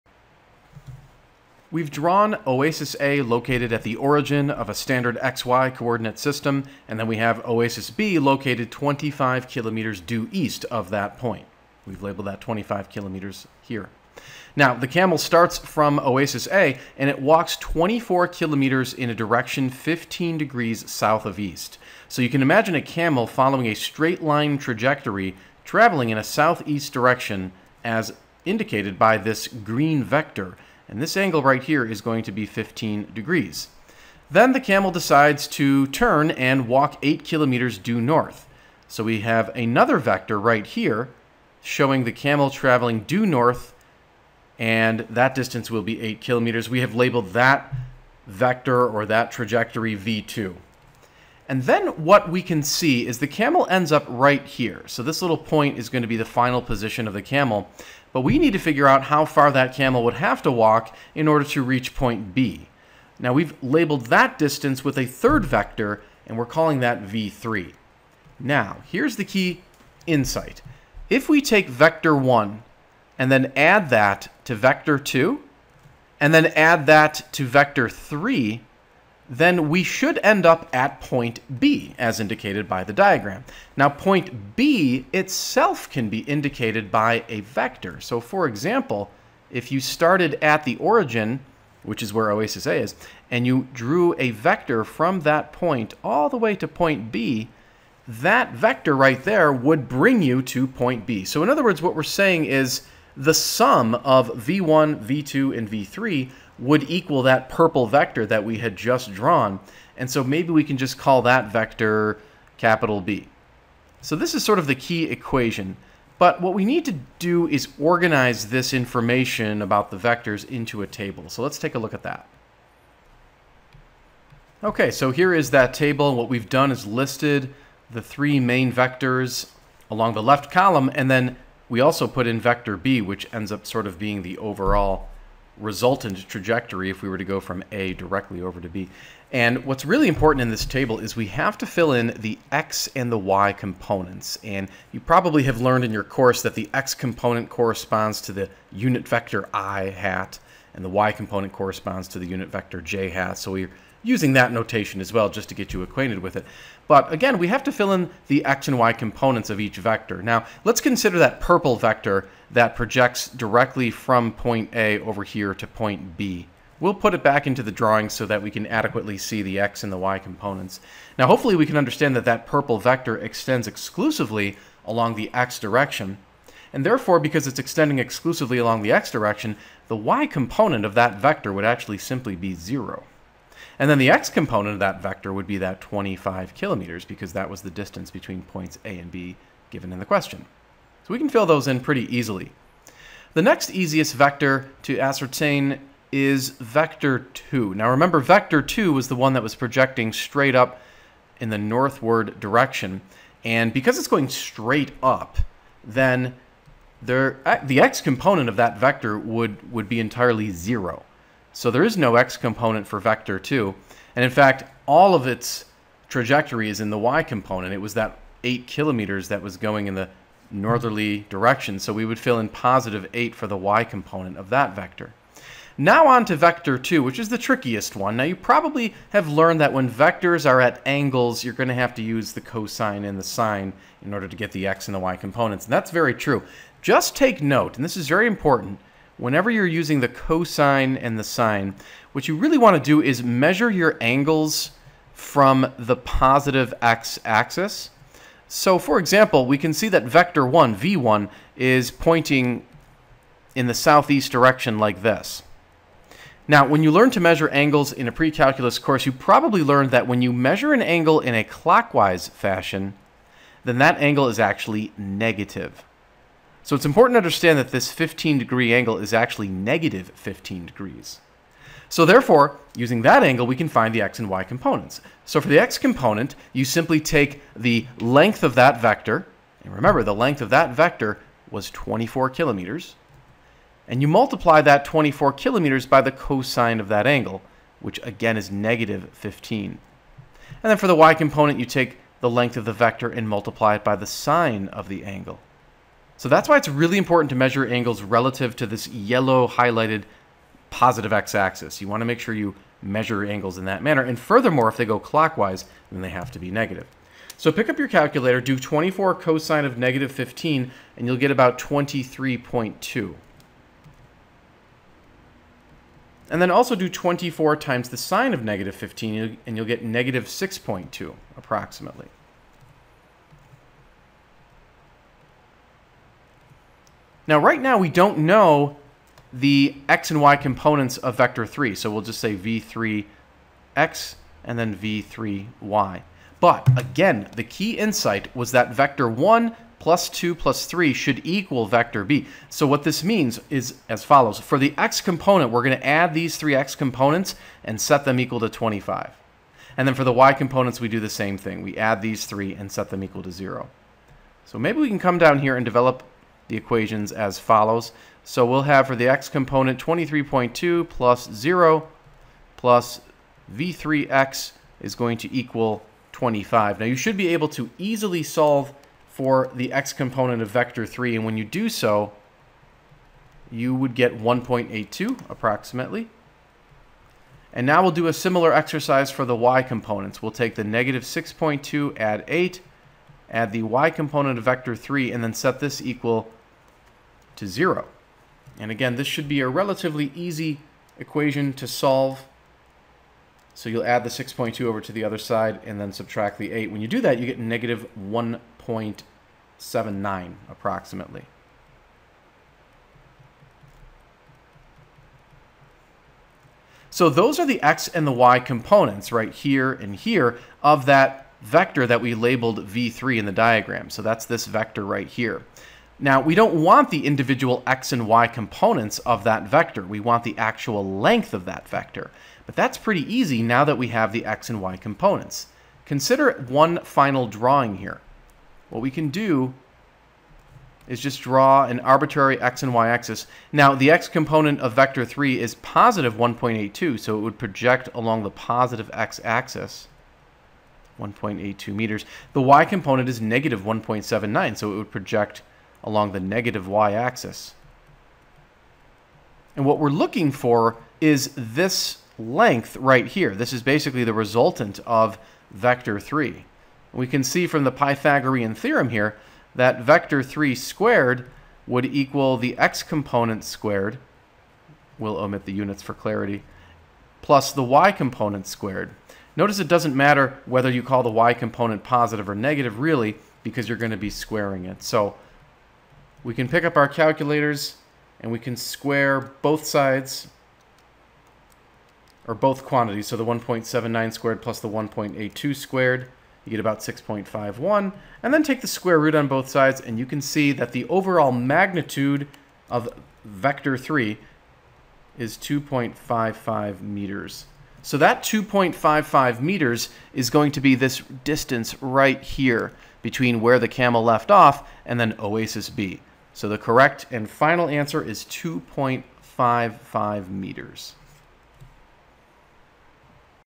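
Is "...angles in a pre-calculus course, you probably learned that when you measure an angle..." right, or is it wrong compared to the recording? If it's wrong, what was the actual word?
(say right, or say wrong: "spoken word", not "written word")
right.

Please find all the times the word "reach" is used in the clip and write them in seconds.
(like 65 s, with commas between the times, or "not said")
61 s.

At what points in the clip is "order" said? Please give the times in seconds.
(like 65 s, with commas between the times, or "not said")
61 s, 234 s.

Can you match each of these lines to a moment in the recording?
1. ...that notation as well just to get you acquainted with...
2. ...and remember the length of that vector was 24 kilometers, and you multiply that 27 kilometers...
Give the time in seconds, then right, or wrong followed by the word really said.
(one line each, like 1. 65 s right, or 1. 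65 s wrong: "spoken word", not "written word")
1. 154 s right
2. 279 s wrong: "24", not "27".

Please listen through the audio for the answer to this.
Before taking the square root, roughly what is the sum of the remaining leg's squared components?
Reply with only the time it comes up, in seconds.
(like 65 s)
486 s.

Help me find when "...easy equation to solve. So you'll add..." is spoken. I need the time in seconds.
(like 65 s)
390 s.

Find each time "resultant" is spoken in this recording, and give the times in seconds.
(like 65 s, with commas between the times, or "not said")
135 s, 454 s.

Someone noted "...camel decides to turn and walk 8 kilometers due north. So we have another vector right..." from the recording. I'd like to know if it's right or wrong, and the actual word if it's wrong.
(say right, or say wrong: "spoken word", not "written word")
right.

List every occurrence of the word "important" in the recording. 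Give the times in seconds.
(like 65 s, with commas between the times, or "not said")
140 s, 238 s, 266 s, 296 s.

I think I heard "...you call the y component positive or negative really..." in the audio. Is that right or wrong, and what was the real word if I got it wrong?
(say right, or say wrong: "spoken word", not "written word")
right.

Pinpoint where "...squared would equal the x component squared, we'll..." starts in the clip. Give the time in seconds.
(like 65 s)
460 s.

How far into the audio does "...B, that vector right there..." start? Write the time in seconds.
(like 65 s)
97 s.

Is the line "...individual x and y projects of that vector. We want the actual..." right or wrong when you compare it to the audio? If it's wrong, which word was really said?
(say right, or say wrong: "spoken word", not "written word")
wrong: "components", not "projects".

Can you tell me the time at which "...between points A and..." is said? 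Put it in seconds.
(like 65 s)
188 s.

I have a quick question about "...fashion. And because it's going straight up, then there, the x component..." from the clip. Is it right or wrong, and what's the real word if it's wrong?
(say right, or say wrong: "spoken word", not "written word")
wrong: "direction", not "fashion".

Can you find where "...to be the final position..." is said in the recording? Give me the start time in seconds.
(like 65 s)
56 s.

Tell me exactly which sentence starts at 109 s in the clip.
And so maybe we can just call that vector capital B.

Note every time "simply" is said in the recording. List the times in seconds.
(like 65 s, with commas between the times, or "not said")
181 s, 276 s.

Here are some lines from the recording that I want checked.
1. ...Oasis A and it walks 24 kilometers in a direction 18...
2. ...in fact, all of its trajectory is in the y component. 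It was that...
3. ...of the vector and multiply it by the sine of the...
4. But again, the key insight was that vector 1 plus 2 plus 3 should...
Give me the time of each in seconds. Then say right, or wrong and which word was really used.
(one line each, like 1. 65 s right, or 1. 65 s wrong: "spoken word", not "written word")
1. 15 s wrong: "15", not "18"
2. 214 s right
3. 292 s right
4. 336 s right.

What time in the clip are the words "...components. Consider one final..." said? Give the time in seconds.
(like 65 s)
424 s.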